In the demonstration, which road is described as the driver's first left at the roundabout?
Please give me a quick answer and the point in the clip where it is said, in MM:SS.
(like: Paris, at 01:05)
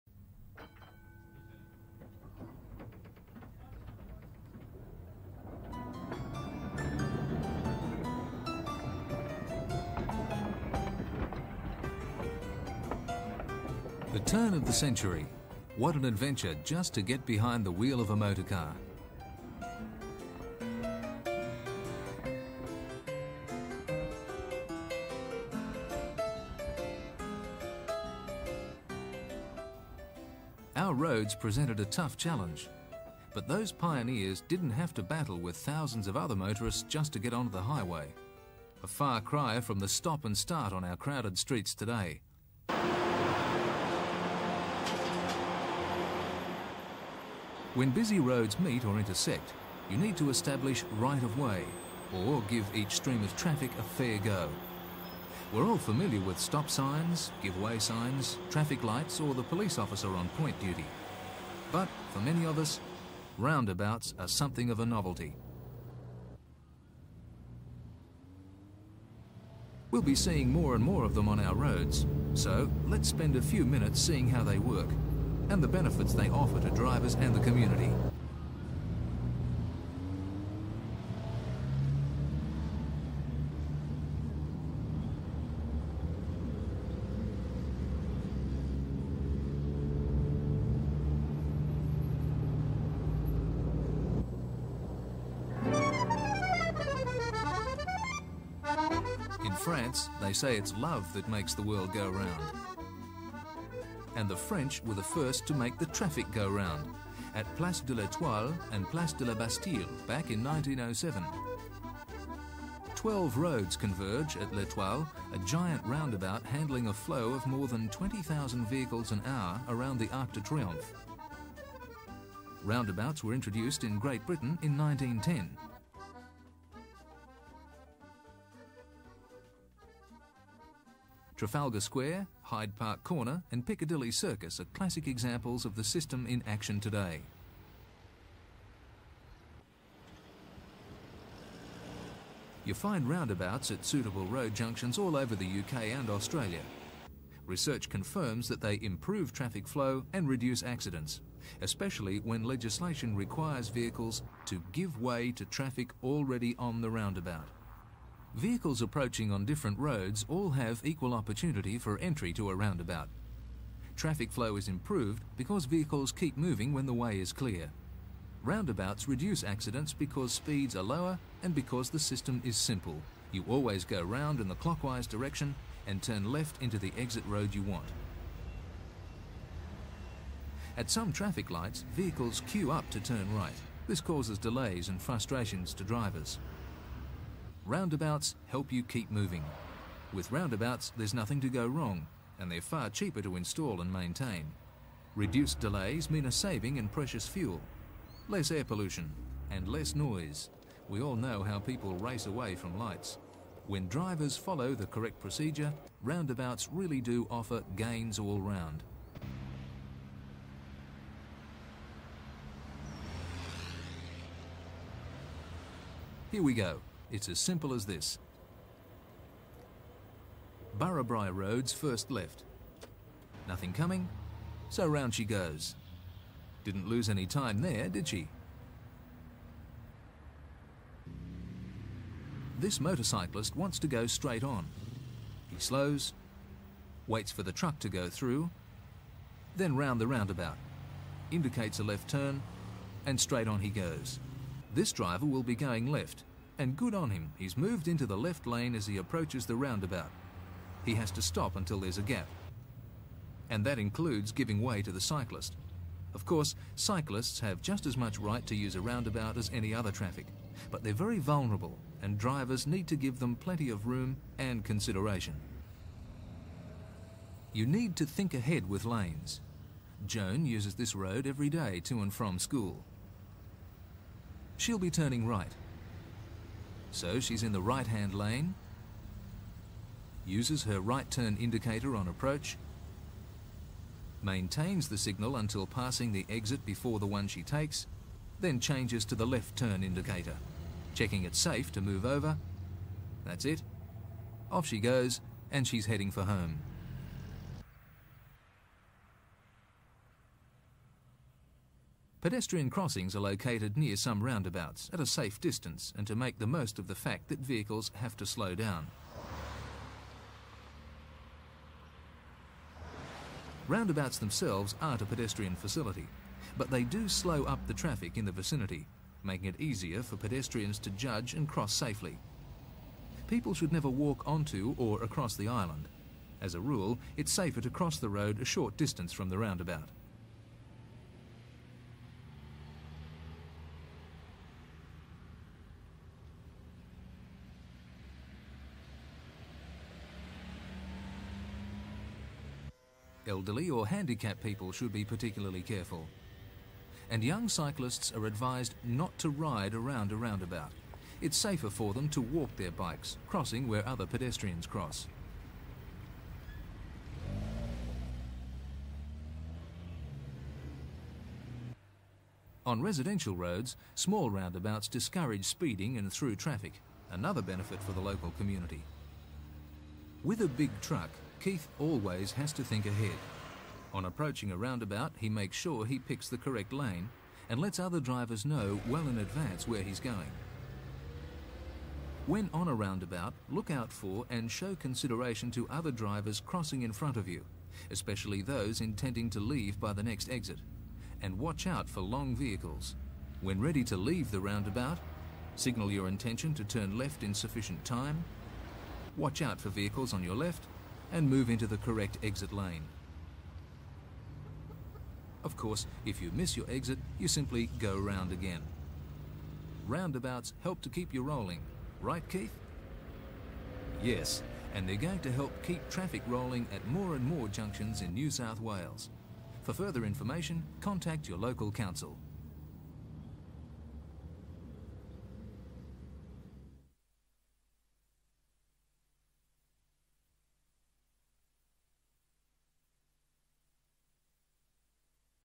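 Barrabri Road, at 03:40.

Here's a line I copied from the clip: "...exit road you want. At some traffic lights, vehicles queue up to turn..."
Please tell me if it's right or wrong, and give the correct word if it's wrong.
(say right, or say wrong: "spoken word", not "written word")
right.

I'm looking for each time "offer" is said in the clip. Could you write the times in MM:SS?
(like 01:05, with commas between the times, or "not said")
01:16, 03:27.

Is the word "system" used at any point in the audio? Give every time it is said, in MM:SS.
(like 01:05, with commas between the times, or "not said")
02:15, 02:51.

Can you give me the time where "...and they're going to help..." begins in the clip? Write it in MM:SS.
06:54.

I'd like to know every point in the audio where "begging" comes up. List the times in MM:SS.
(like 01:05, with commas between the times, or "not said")
not said.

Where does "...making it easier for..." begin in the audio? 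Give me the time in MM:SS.
05:19.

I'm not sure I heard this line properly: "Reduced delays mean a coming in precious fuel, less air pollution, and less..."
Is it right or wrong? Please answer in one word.
wrong.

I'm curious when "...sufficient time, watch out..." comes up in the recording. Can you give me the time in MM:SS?
06:37.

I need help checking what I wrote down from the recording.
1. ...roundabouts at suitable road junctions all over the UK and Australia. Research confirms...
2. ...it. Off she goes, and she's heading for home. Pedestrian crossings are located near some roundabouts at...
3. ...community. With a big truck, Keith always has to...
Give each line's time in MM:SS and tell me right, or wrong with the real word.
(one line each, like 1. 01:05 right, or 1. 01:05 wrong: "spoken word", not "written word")
1. 02:23 right
2. 04:53 right
3. 06:08 right.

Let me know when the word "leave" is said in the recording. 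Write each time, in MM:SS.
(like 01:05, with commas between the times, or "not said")
06:29, 06:33.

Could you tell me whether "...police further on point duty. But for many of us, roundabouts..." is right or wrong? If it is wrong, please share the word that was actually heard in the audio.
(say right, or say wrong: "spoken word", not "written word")
wrong: "officer", not "further".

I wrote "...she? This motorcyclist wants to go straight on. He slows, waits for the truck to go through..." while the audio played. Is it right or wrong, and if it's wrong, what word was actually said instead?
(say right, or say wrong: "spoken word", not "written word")
right.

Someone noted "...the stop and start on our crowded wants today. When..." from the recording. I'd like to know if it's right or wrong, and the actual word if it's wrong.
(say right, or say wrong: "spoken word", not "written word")
wrong: "streets", not "wants".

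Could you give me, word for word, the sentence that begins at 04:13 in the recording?
And that includes giving way to the cyclist.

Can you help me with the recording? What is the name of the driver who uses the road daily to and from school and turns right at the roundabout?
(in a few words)
Joan.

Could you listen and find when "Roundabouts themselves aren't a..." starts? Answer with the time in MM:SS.
05:13.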